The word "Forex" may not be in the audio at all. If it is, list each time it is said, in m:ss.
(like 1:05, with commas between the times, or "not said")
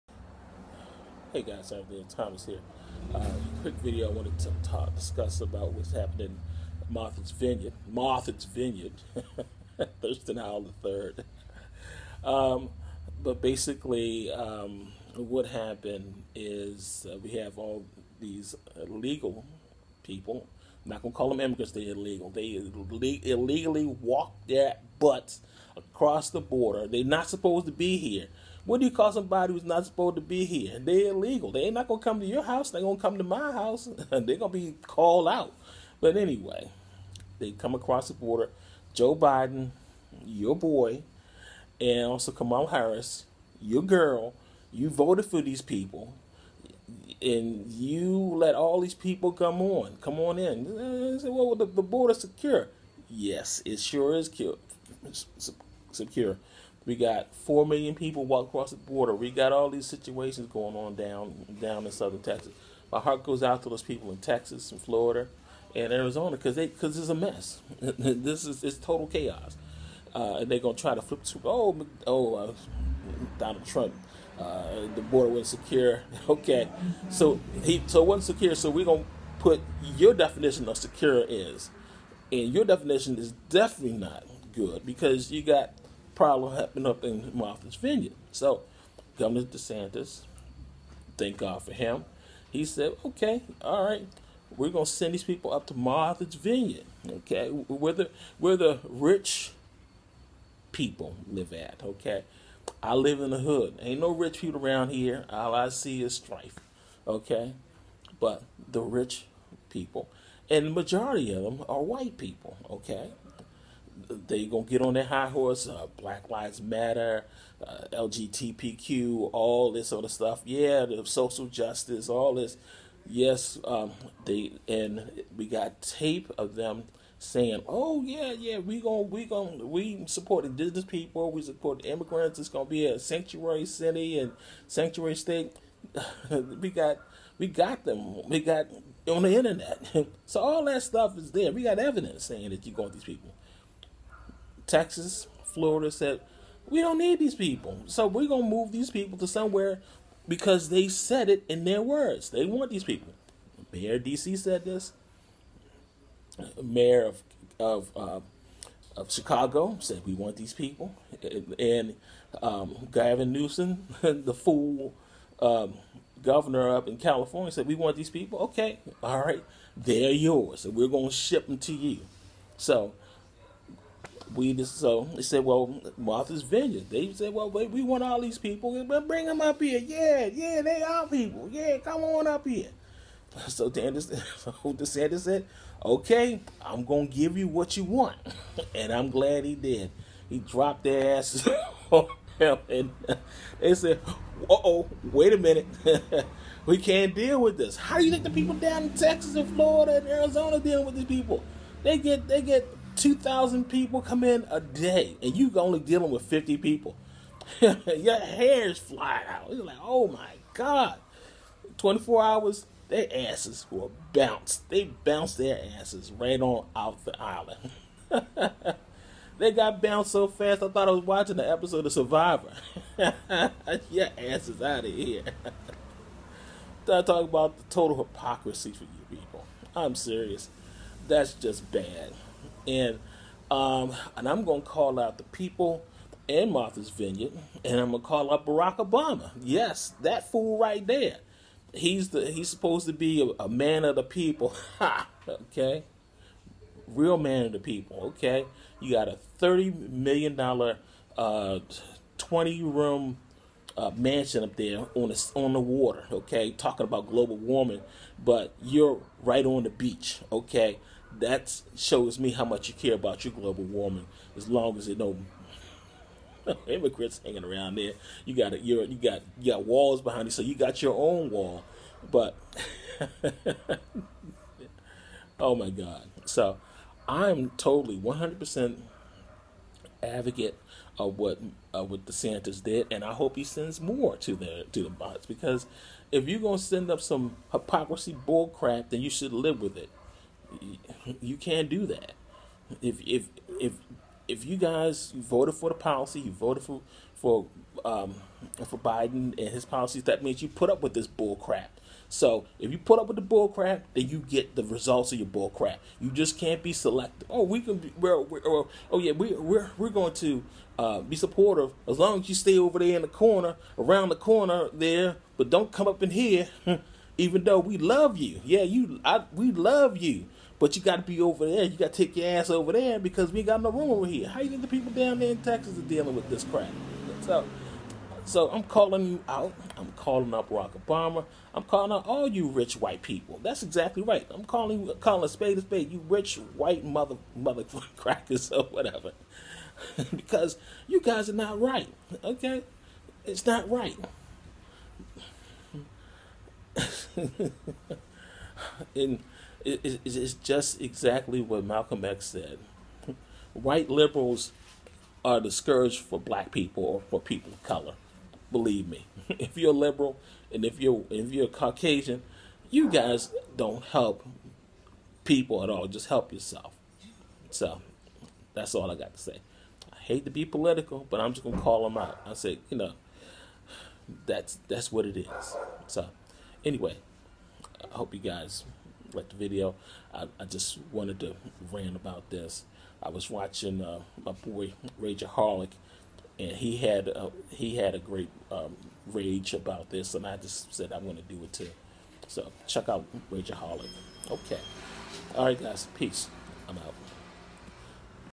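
not said.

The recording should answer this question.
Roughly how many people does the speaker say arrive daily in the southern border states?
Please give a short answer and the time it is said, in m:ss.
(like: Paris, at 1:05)
2,000, at 3:22.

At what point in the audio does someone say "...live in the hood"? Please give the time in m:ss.
1:42.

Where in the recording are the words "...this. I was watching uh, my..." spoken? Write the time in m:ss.
6:22.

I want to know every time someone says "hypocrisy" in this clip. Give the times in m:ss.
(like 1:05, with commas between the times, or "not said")
3:47, 4:47.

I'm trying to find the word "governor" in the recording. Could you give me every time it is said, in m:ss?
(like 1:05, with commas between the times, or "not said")
1:29, 2:46.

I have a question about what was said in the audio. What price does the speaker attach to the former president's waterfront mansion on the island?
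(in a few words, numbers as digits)
$30 million.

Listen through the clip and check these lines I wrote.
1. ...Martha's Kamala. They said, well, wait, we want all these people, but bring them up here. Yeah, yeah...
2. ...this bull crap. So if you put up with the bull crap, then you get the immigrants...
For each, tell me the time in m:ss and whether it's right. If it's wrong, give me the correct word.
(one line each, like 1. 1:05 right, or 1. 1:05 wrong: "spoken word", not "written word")
1. 2:55 wrong: "Vineyard", not "Kamala"
2. 5:00 wrong: "results", not "immigrants".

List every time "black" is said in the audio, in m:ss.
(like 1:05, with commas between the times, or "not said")
1:55, 5:56.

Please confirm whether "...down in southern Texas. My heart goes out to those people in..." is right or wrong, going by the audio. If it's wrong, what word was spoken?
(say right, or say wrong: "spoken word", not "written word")
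right.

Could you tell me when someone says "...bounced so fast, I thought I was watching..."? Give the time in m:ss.
3:39.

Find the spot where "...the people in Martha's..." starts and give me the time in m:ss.
3:55.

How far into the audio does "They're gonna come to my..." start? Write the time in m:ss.
0:32.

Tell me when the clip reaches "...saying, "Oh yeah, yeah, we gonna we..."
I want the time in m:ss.
2:07.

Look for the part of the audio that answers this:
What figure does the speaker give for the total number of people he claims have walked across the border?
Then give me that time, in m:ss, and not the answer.
0:57.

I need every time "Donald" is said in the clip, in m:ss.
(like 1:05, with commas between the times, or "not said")
1:13.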